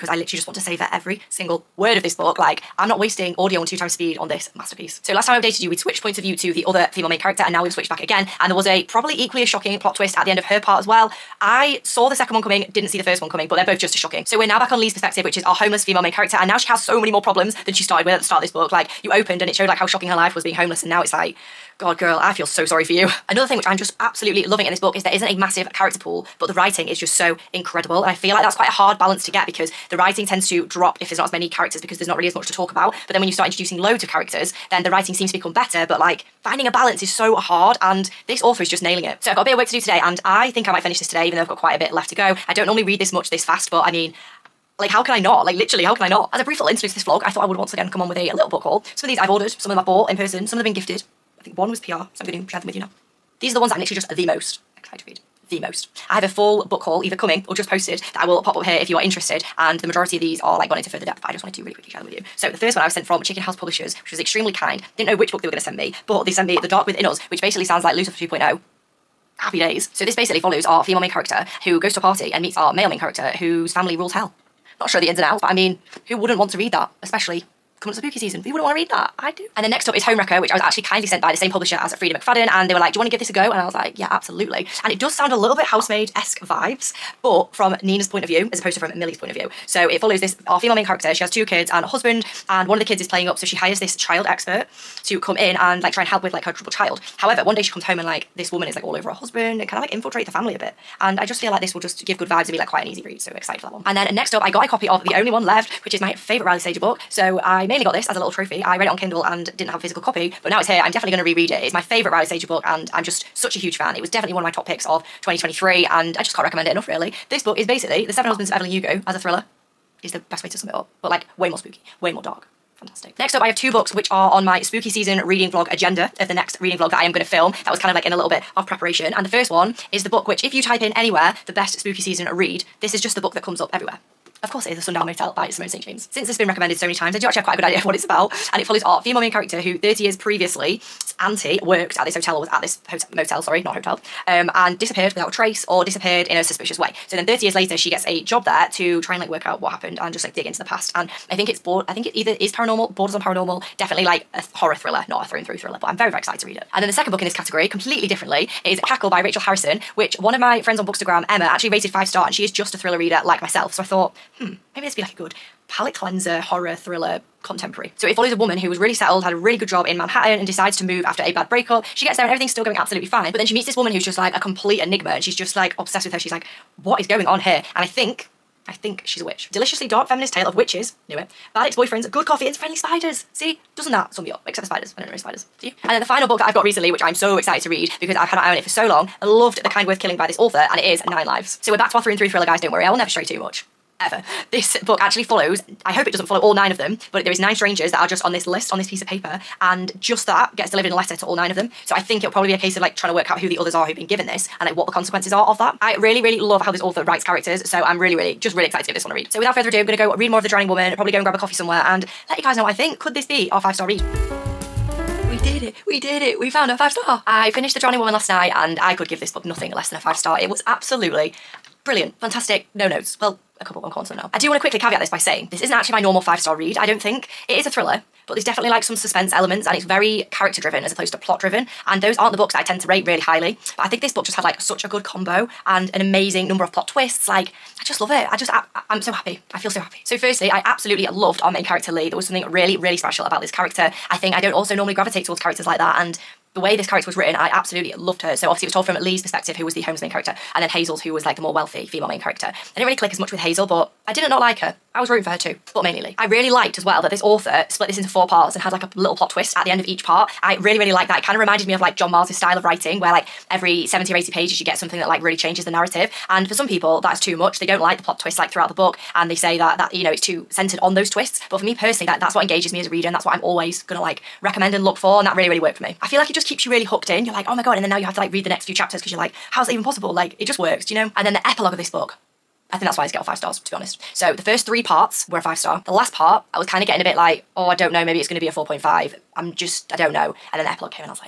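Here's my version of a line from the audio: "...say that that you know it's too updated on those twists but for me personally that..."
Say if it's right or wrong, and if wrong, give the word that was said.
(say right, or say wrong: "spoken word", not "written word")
wrong: "centered", not "updated".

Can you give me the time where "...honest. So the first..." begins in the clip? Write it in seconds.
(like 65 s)
283 s.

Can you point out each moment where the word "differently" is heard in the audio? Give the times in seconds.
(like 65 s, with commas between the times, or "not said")
158 s.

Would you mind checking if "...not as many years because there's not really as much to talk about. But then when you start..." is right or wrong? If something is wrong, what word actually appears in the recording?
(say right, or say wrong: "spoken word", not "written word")
wrong: "characters", not "years".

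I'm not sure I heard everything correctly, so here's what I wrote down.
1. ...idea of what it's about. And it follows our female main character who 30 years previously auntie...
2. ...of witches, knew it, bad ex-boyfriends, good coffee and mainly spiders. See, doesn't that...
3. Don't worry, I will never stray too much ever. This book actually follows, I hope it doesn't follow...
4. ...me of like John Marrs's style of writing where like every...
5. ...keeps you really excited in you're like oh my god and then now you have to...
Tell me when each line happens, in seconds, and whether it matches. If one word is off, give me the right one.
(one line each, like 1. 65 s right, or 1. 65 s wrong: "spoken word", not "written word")
1. 137 s right
2. 180 s wrong: "friendly", not "mainly"
3. 192 s right
4. 261 s right
5. 276 s wrong: "hooked", not "excited".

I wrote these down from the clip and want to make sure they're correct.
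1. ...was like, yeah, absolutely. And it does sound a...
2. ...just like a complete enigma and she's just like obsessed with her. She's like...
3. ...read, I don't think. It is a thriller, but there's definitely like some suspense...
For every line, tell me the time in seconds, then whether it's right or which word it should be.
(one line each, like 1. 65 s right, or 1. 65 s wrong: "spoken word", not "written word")
1. 83 s right
2. 174 s right
3. 226 s right.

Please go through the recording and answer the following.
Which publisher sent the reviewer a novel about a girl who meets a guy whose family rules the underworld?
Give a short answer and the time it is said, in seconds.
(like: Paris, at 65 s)
Chicken House, at 63 s.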